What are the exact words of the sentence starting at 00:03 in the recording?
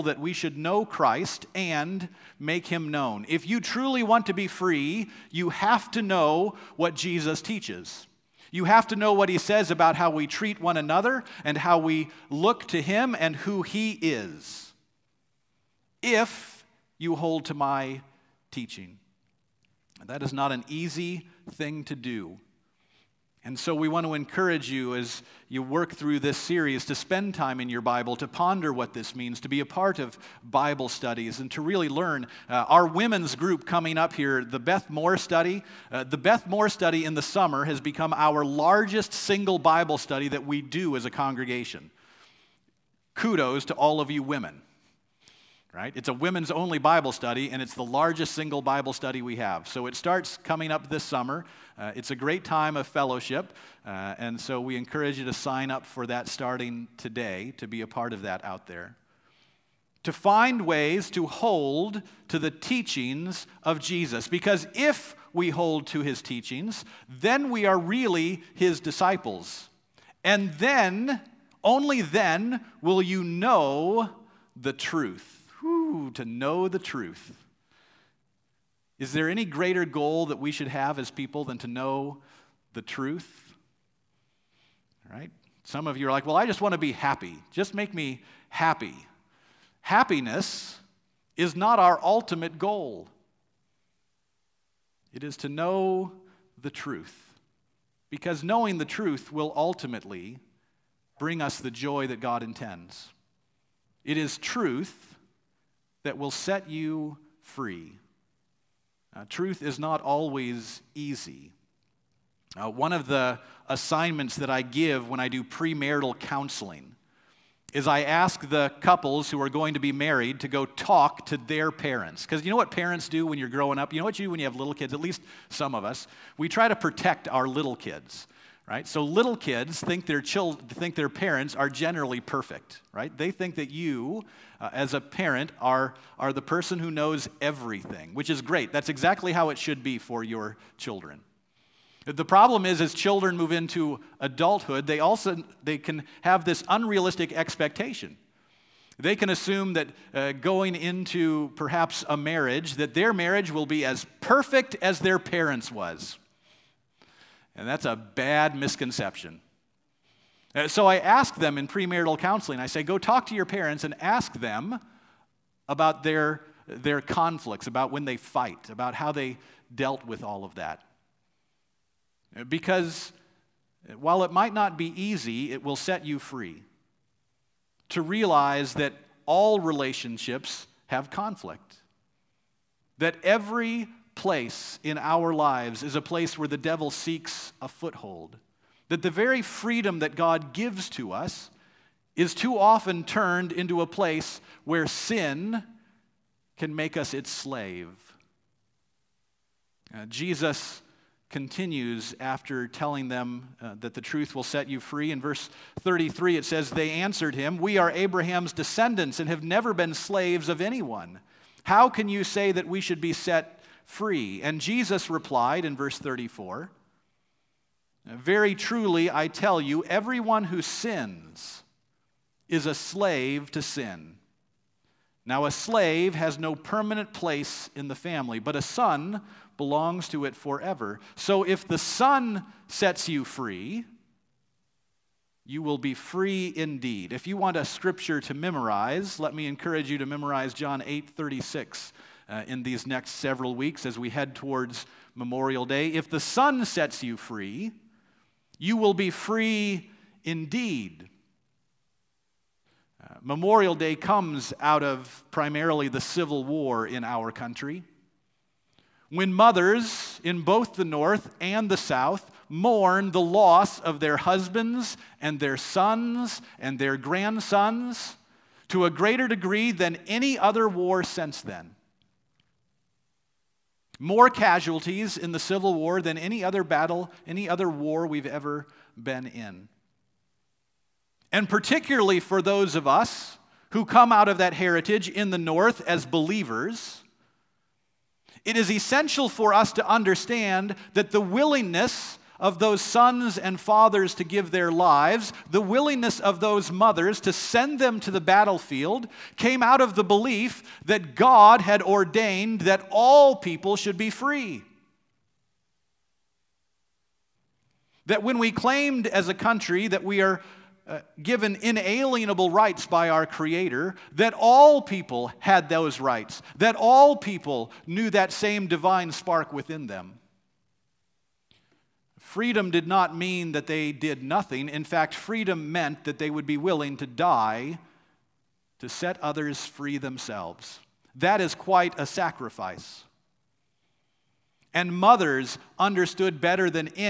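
If you truly want to be free, you have to know what Jesus teaches.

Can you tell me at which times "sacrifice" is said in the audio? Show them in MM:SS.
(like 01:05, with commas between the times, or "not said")
05:32.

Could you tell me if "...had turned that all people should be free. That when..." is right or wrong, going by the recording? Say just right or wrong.
wrong.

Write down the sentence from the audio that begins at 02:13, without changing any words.
They think that you, uh, as a parent, are are the person who knows everything, which is great.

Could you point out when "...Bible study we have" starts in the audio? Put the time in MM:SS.
00:48.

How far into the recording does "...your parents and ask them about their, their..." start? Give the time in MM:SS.
02:43.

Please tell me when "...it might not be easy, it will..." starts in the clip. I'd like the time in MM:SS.
02:54.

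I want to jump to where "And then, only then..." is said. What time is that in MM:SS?
01:10.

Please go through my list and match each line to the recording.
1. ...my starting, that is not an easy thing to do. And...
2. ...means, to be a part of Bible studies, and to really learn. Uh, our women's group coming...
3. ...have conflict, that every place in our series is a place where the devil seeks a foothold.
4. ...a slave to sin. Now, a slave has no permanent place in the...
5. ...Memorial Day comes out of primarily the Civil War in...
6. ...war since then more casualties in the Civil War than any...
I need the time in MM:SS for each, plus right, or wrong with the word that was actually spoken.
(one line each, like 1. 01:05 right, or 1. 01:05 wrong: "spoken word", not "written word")
1. 00:17 wrong: "teaching", not "starting"
2. 00:29 right
3. 03:00 wrong: "lives", not "series"
4. 03:42 right
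5. 04:13 right
6. 04:30 right.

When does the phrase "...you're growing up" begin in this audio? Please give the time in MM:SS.
02:03.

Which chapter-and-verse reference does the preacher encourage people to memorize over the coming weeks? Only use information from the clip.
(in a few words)
John 8:36.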